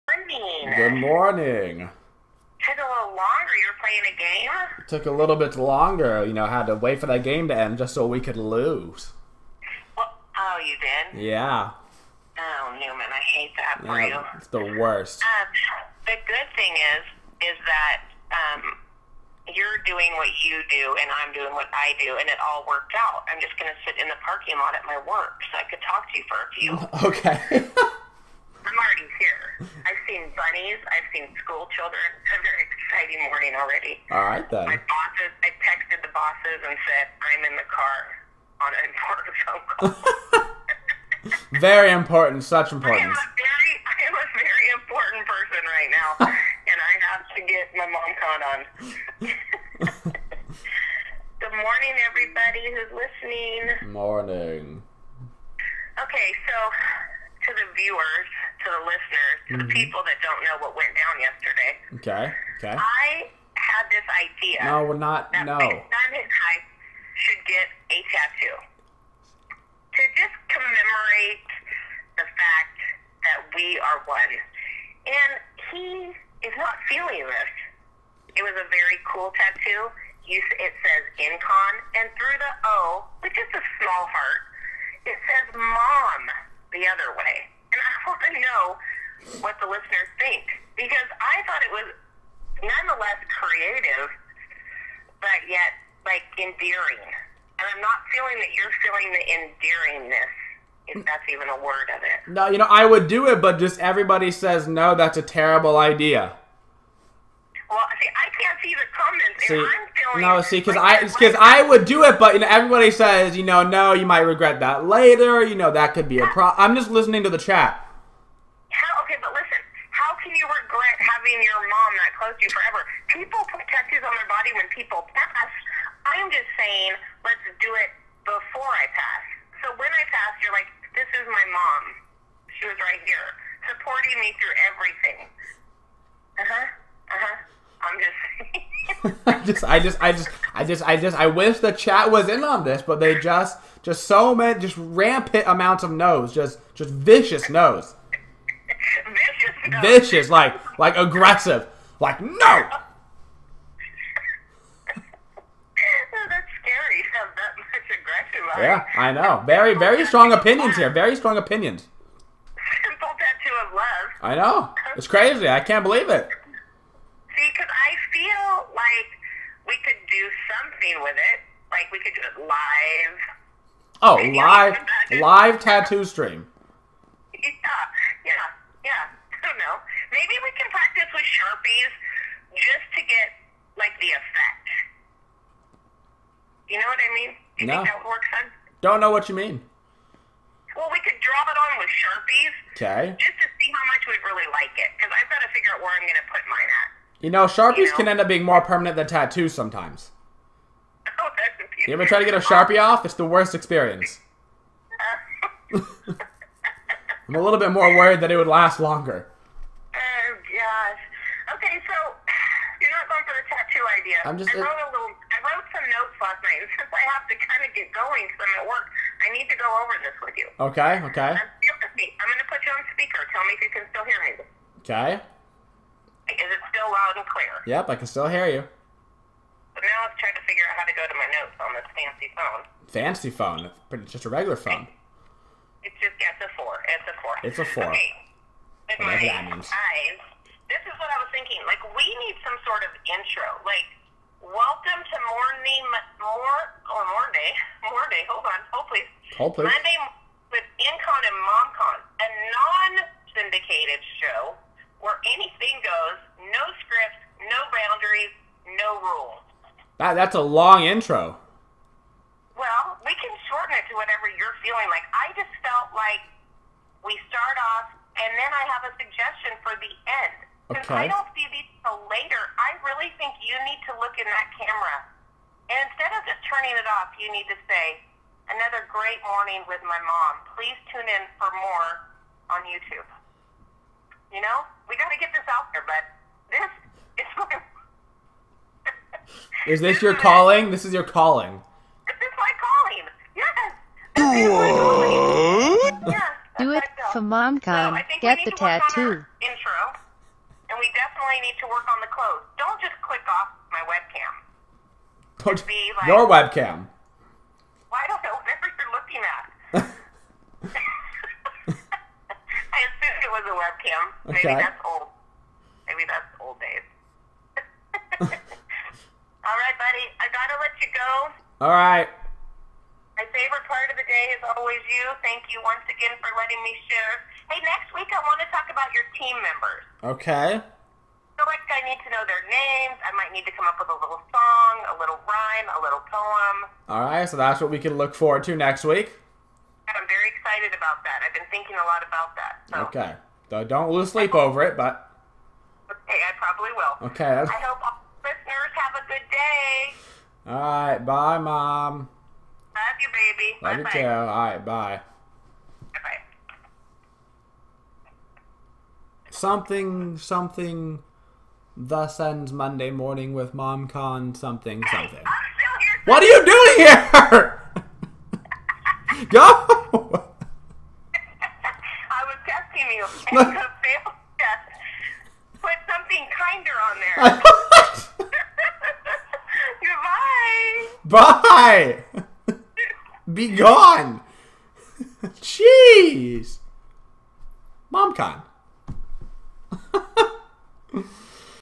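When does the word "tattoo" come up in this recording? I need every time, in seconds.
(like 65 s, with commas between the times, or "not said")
68 s, 79 s, 123 s, 163 s, 175 s, 199 s, 298 s.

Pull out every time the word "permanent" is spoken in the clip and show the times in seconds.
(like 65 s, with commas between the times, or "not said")
198 s.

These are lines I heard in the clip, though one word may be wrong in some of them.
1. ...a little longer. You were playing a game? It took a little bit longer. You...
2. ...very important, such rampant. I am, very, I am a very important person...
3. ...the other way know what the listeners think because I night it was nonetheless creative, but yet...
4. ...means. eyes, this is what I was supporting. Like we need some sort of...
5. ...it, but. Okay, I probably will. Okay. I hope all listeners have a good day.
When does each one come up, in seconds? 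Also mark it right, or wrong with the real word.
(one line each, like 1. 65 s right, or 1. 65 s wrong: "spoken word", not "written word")
1. 2 s right
2. 41 s wrong: "important", not "rampant"
3. 86 s wrong: "thought", not "night"
4. 239 s wrong: "thinking", not "supporting"
5. 344 s right.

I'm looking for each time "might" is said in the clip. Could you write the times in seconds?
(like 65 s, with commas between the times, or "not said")
114 s, 333 s.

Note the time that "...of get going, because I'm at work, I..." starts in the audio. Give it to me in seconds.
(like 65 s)
217 s.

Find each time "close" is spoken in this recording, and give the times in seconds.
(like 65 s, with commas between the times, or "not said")
122 s.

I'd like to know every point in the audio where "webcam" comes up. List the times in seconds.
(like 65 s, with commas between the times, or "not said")
306 s, 313 s.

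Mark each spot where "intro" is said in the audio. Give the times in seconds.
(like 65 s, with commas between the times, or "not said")
243 s, 260 s.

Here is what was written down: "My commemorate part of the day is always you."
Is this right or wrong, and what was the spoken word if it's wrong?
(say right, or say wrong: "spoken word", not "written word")
wrong: "favorite", not "commemorate".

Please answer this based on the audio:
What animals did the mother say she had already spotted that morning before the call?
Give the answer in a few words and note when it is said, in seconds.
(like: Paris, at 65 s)
bunnies, at 30 s.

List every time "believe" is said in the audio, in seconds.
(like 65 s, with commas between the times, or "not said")
165 s.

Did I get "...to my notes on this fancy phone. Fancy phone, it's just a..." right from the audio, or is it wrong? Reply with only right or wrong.
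right.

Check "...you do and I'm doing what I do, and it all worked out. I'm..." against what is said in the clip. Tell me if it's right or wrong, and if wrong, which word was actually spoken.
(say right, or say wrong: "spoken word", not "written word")
right.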